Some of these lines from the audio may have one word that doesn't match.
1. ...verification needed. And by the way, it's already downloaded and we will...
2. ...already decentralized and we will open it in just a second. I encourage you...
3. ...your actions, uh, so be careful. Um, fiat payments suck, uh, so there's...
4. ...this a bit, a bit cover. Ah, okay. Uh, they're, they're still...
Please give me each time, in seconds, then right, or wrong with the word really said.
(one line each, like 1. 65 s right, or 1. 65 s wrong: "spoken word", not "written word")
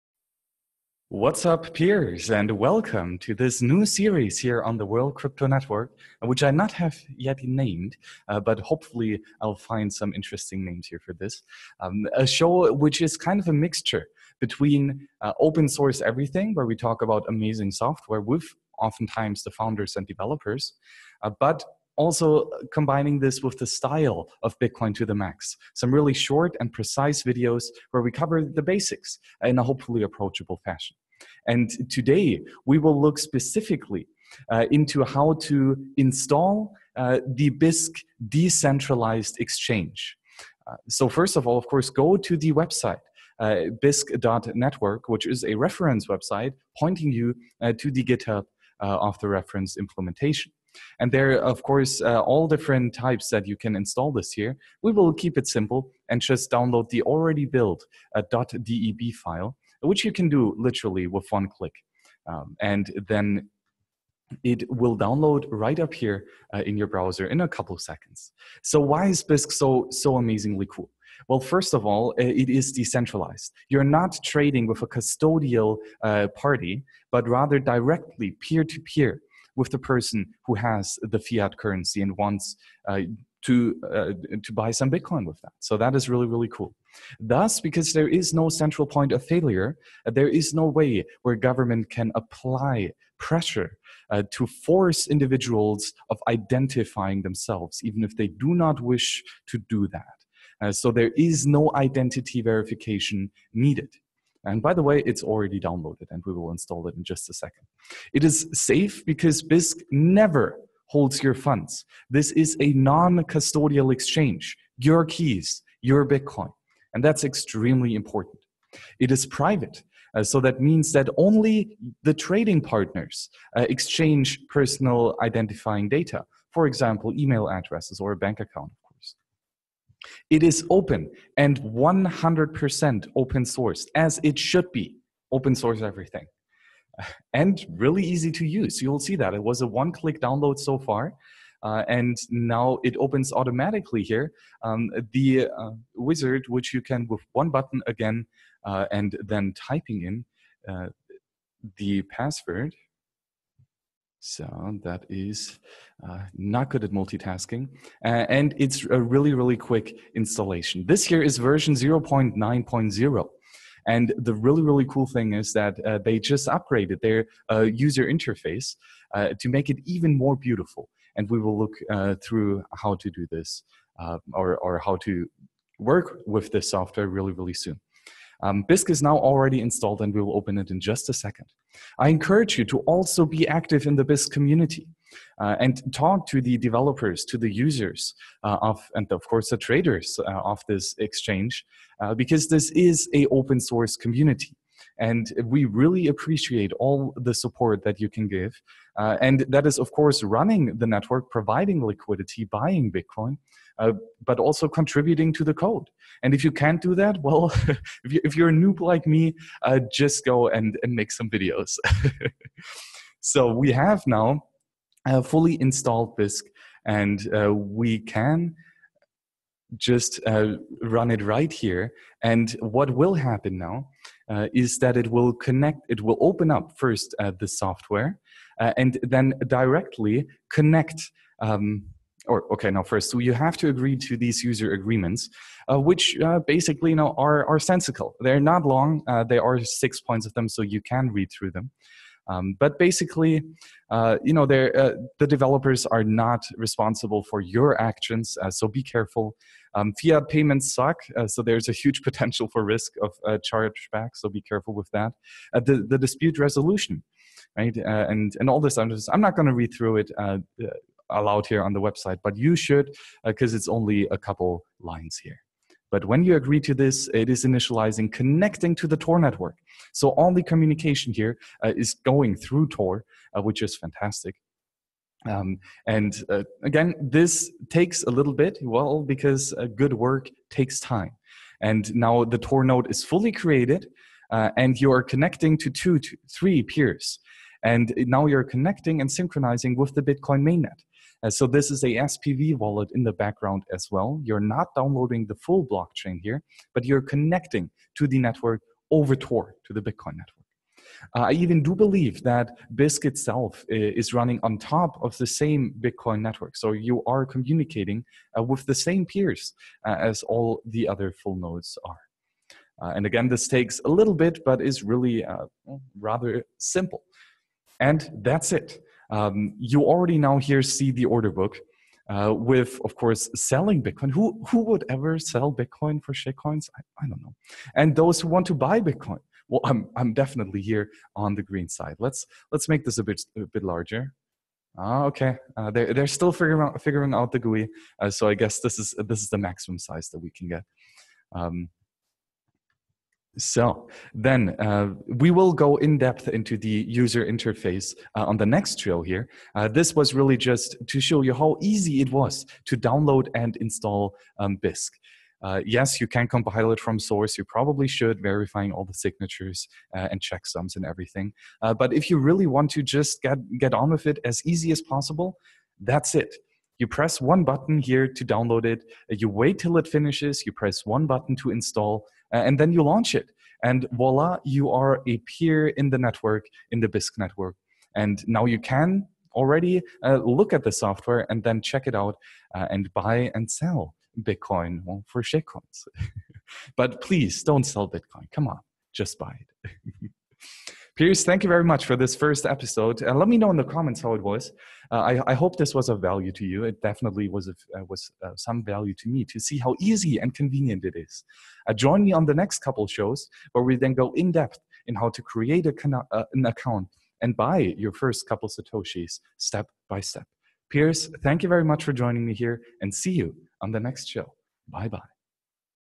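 1. 102 s right
2. 179 s wrong: "installed", not "decentralized"
3. 247 s right
4. 332 s wrong: "larger", not "cover".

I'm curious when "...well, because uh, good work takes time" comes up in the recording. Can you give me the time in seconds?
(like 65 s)
278 s.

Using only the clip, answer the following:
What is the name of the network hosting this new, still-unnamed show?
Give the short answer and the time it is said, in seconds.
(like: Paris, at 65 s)
World Crypto Network, at 4 s.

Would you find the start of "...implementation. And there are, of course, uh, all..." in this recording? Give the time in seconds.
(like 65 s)
49 s.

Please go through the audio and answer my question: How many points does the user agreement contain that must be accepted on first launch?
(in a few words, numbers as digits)
6.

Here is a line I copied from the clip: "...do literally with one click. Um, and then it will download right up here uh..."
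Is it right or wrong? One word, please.
right.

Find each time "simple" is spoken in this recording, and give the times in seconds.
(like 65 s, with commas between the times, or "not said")
55 s, 316 s.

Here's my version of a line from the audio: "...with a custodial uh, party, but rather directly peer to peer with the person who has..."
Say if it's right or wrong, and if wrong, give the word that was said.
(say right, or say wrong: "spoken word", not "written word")
right.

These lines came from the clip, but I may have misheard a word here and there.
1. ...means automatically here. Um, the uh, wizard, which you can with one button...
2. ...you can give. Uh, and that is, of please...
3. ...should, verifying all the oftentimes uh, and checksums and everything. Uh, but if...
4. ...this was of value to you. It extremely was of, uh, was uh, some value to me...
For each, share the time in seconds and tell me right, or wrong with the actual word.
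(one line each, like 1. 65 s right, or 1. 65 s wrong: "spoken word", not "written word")
1. 142 s wrong: "opens", not "means"
2. 197 s wrong: "course", not "please"
3. 357 s wrong: "signatures", not "oftentimes"
4. 395 s wrong: "definitely", not "extremely".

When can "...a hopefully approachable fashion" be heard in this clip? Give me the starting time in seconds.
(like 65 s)
29 s.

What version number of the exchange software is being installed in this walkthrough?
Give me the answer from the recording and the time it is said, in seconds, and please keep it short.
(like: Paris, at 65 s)
0.9.0, at 161 s.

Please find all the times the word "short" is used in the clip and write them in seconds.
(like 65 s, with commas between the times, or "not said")
26 s.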